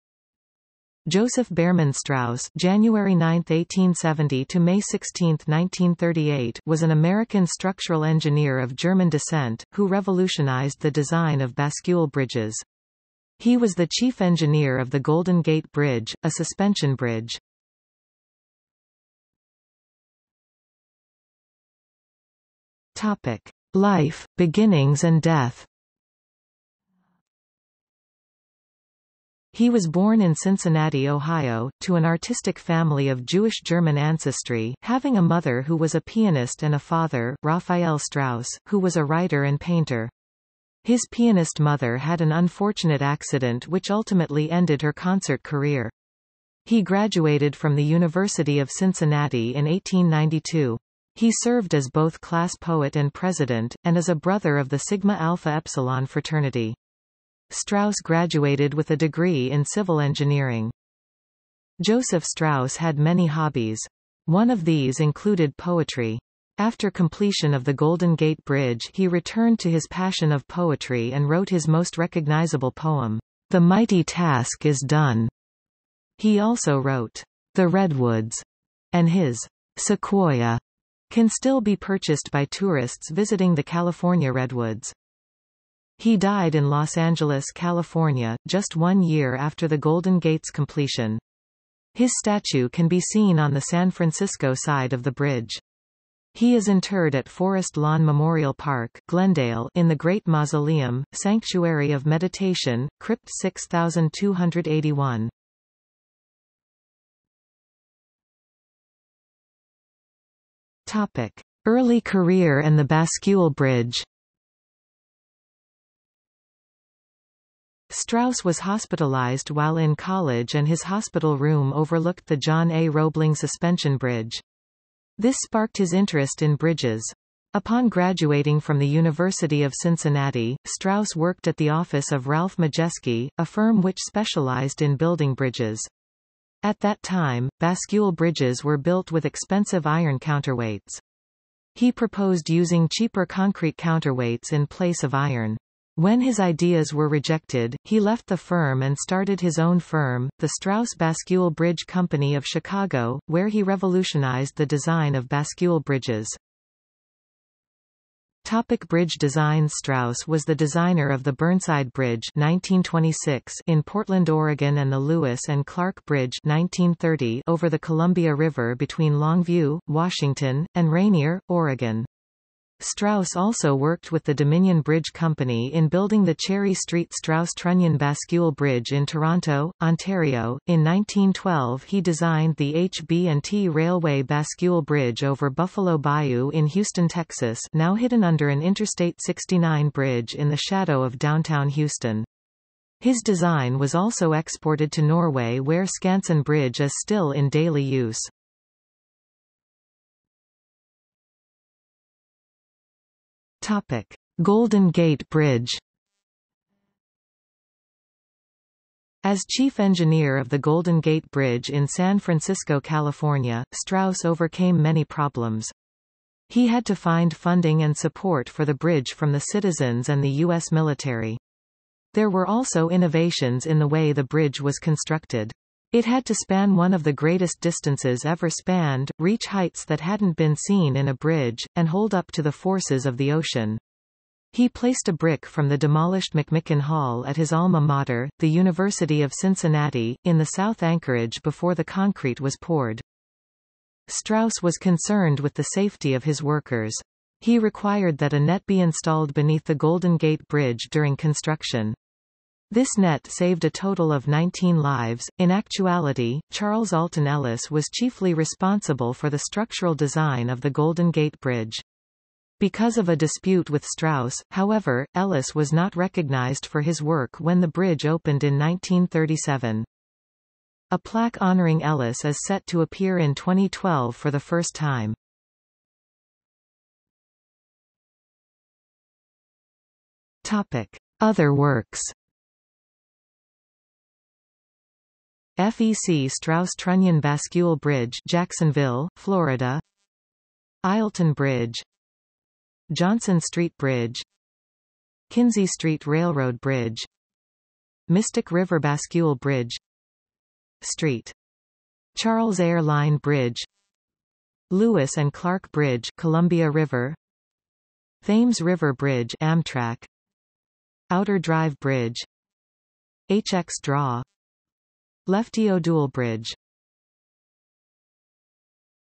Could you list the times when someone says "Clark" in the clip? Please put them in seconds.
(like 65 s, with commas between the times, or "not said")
165 s, 305 s.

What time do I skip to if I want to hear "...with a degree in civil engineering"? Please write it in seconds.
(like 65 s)
58 s.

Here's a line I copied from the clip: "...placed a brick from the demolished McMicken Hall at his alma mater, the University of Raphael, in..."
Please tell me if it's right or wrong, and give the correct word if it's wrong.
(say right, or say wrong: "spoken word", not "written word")
wrong: "Cincinnati", not "Raphael".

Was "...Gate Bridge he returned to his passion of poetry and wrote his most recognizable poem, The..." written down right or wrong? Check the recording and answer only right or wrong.
right.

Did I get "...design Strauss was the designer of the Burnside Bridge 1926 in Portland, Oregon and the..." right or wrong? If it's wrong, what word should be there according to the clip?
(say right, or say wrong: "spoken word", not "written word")
right.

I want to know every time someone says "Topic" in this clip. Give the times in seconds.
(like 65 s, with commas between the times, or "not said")
22 s, 110 s, 158 s, 203 s, 280 s.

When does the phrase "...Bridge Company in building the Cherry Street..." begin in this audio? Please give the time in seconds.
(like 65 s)
174 s.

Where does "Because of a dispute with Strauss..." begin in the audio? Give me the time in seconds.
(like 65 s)
262 s.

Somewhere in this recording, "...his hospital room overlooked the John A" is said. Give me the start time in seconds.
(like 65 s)
120 s.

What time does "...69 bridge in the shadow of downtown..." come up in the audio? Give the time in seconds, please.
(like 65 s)
189 s.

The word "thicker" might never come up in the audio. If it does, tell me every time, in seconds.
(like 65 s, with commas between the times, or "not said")
not said.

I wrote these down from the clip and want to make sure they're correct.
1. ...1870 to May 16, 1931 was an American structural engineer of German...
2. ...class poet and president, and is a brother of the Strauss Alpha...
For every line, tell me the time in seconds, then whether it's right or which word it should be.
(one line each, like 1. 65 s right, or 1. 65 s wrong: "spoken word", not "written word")
1. 3 s wrong: "1938", not "1931"
2. 52 s wrong: "Sigma", not "Strauss".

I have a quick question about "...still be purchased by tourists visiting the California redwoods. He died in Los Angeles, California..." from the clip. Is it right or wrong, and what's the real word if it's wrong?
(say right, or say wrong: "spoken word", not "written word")
right.